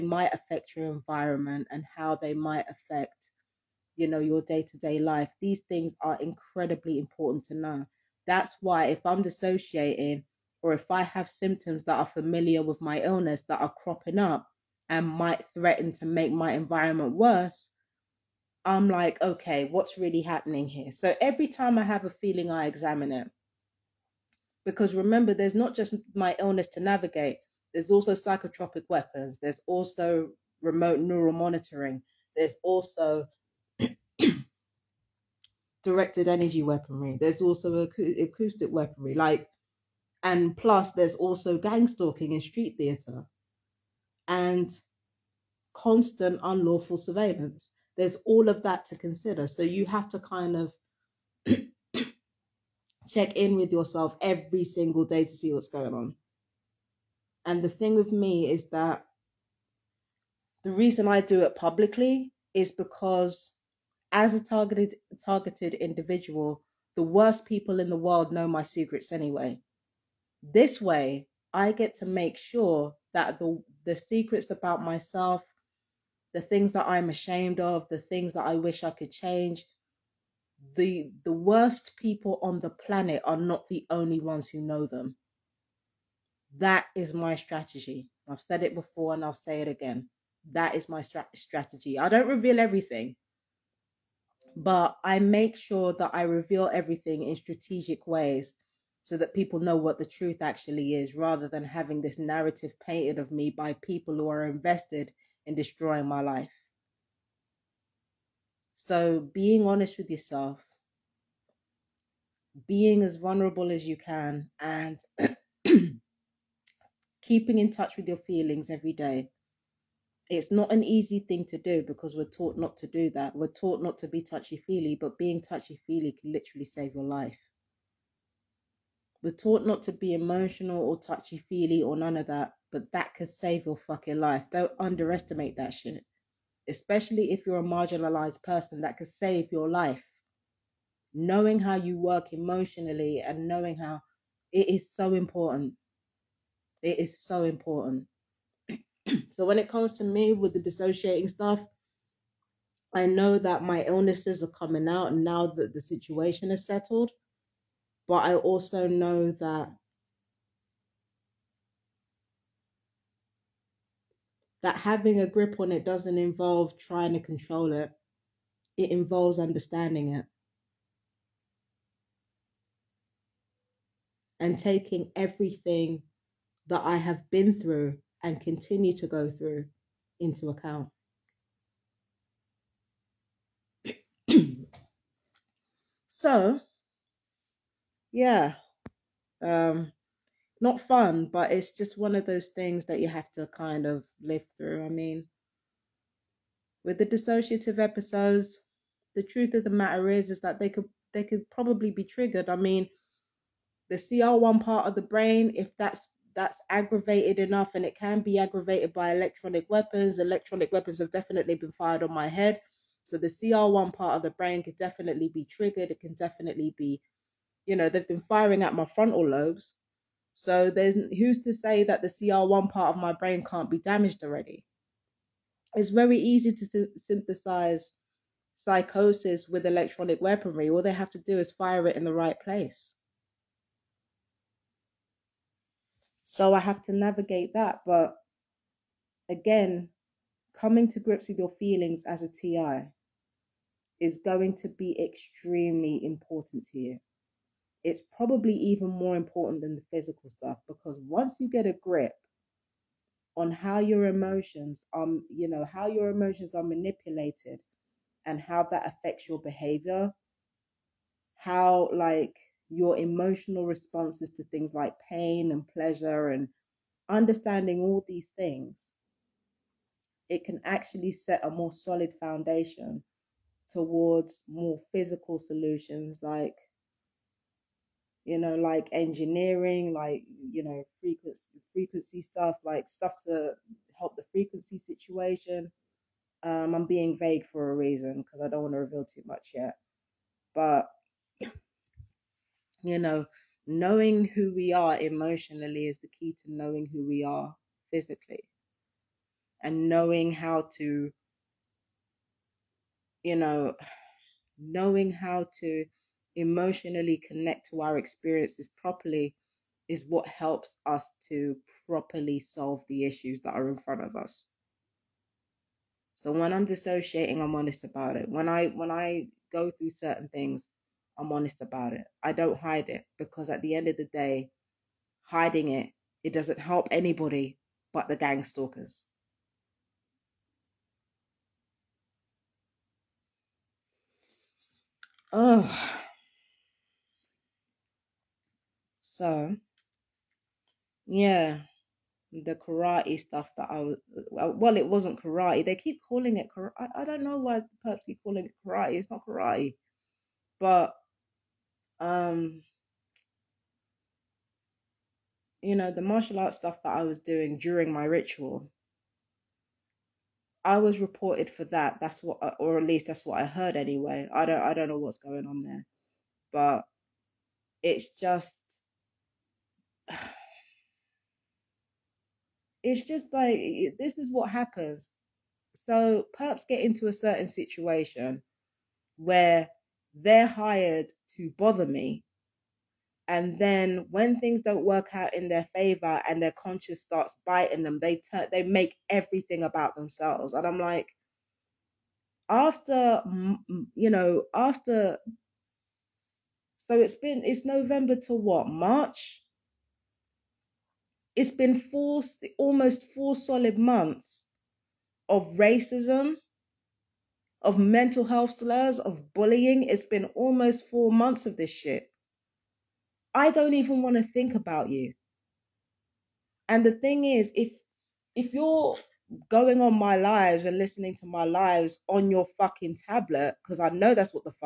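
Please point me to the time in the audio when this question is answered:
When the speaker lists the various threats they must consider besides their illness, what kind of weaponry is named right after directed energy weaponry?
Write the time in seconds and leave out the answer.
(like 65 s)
38 s.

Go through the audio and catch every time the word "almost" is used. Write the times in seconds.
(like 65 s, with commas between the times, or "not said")
402 s, 410 s.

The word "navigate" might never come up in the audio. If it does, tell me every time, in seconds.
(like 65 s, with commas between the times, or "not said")
26 s, 236 s.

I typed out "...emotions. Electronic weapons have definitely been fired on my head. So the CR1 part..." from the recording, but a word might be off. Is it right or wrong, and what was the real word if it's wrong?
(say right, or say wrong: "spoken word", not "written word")
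wrong: "weapons", not "emotions".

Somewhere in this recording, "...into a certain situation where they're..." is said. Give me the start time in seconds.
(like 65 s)
376 s.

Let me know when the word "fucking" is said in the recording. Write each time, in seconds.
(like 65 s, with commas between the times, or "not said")
133 s, 422 s.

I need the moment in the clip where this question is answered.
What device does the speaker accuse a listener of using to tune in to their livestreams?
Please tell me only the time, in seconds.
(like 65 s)
423 s.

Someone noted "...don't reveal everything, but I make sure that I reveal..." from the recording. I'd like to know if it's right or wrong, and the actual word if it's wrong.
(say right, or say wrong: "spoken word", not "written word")
right.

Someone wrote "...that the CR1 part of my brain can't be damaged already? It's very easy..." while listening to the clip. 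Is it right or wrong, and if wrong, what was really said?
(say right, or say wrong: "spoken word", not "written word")
right.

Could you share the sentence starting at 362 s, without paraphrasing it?
That's what, uh, or at least that's what I heard anyway.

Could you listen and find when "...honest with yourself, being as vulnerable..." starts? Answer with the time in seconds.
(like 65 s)
109 s.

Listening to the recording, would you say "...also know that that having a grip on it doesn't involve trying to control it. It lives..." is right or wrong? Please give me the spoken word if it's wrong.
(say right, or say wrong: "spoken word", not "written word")
wrong: "involves", not "lives".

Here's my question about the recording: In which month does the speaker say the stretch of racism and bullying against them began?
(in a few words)
November.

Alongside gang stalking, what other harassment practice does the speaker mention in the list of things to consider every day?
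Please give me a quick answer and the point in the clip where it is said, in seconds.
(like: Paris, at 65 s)
street theatre, at 42 s.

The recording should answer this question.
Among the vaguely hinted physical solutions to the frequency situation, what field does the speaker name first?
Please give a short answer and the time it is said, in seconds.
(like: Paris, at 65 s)
engineering, at 278 s.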